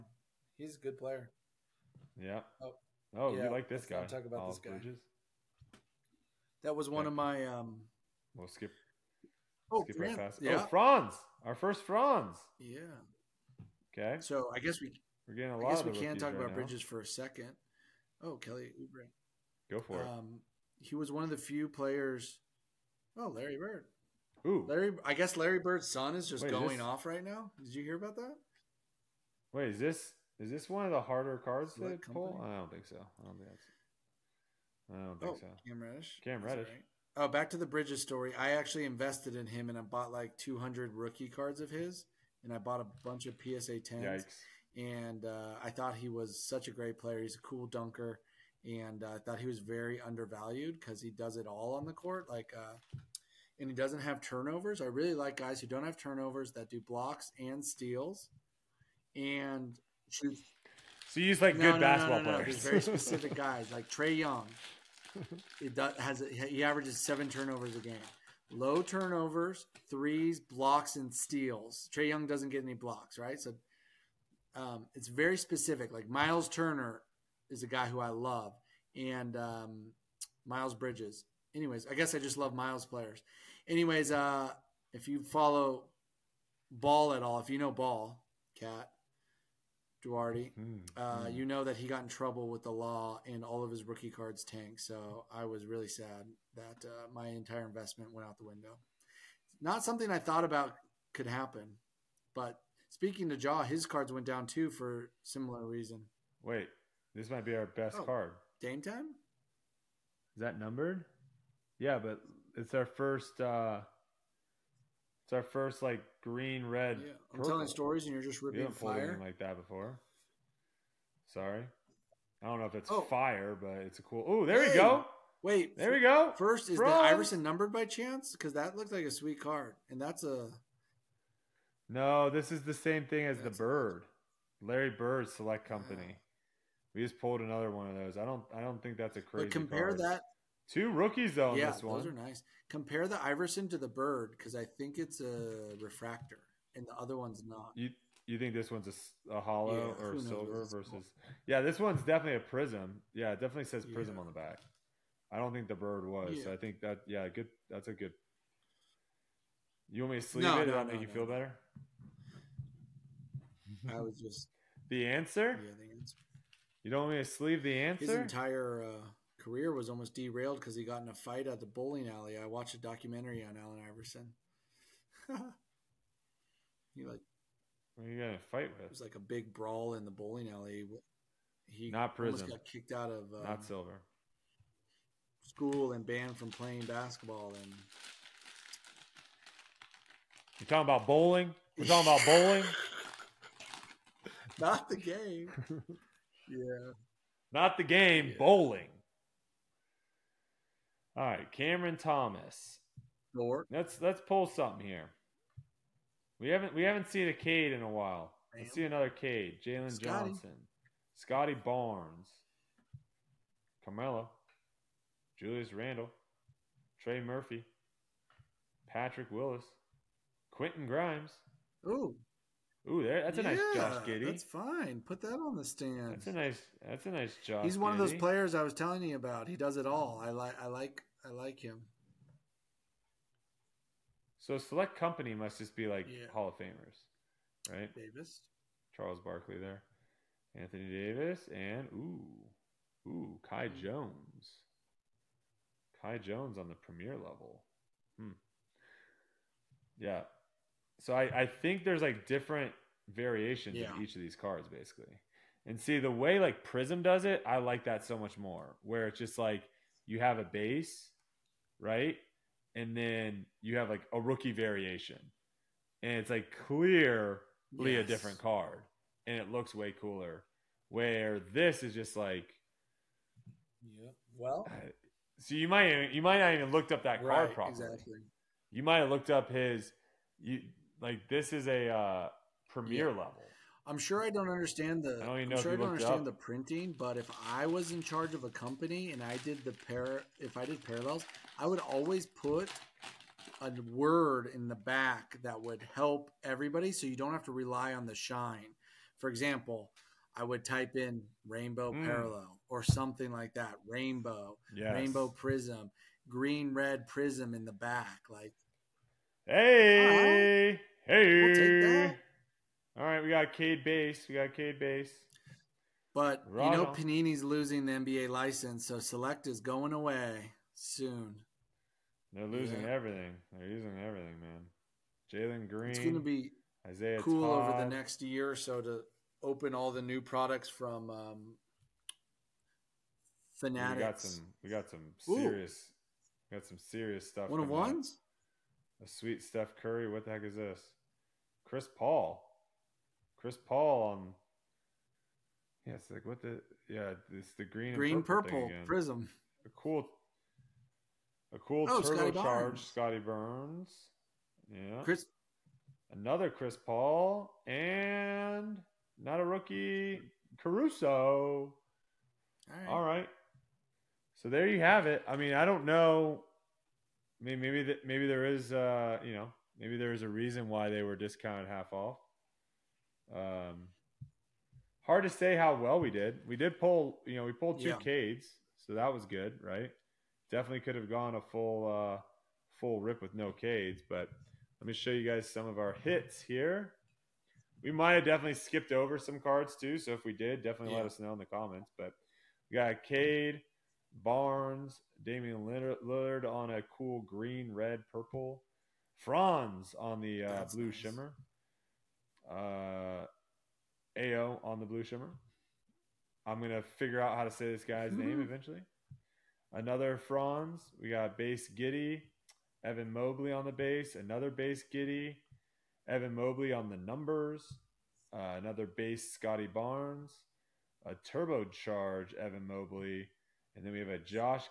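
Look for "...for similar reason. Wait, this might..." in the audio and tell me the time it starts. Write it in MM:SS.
01:44.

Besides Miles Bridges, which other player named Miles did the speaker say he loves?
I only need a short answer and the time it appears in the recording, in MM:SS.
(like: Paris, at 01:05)
Miles Turner, at 01:16.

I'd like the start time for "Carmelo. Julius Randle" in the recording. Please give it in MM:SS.
03:33.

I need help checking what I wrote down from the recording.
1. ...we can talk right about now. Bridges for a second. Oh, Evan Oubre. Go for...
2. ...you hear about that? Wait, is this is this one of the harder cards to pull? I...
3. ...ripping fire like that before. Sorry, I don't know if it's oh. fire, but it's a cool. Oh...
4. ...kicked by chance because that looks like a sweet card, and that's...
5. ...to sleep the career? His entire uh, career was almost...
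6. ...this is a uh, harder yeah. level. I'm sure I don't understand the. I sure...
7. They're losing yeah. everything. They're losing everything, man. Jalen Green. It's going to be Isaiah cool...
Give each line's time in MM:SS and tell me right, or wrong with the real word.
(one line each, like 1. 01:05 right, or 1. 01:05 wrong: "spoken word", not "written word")
1. 00:15 wrong: "Kelly", not "Evan"
2. 00:27 right
3. 01:58 right
4. 02:07 wrong: "numbered", not "kicked"
5. 02:47 wrong: "answer", not "career"
6. 04:41 wrong: "premier", not "harder"
7. 05:22 right.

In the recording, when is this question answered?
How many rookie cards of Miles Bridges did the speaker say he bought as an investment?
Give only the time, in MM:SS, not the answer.
00:40.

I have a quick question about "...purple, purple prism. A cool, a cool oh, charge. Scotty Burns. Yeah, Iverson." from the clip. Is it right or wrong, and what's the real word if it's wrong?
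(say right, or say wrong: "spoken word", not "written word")
wrong: "Chris", not "Iverson".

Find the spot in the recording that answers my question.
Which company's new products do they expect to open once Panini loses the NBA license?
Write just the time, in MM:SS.
05:33.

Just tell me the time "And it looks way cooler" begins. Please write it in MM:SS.
04:29.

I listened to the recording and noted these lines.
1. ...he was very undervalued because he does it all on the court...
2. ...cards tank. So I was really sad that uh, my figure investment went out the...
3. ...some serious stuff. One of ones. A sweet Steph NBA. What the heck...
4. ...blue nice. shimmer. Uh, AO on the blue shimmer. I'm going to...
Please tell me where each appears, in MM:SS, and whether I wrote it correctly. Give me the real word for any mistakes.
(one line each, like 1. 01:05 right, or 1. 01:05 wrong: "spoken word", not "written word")
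1. 00:49 right
2. 01:34 wrong: "entire", not "figure"
3. 05:36 wrong: "Curry", not "NBA"
4. 06:40 right.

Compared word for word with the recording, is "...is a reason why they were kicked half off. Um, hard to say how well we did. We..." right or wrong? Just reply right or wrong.
wrong.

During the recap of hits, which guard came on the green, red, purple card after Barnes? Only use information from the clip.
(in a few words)
Damian Lillard.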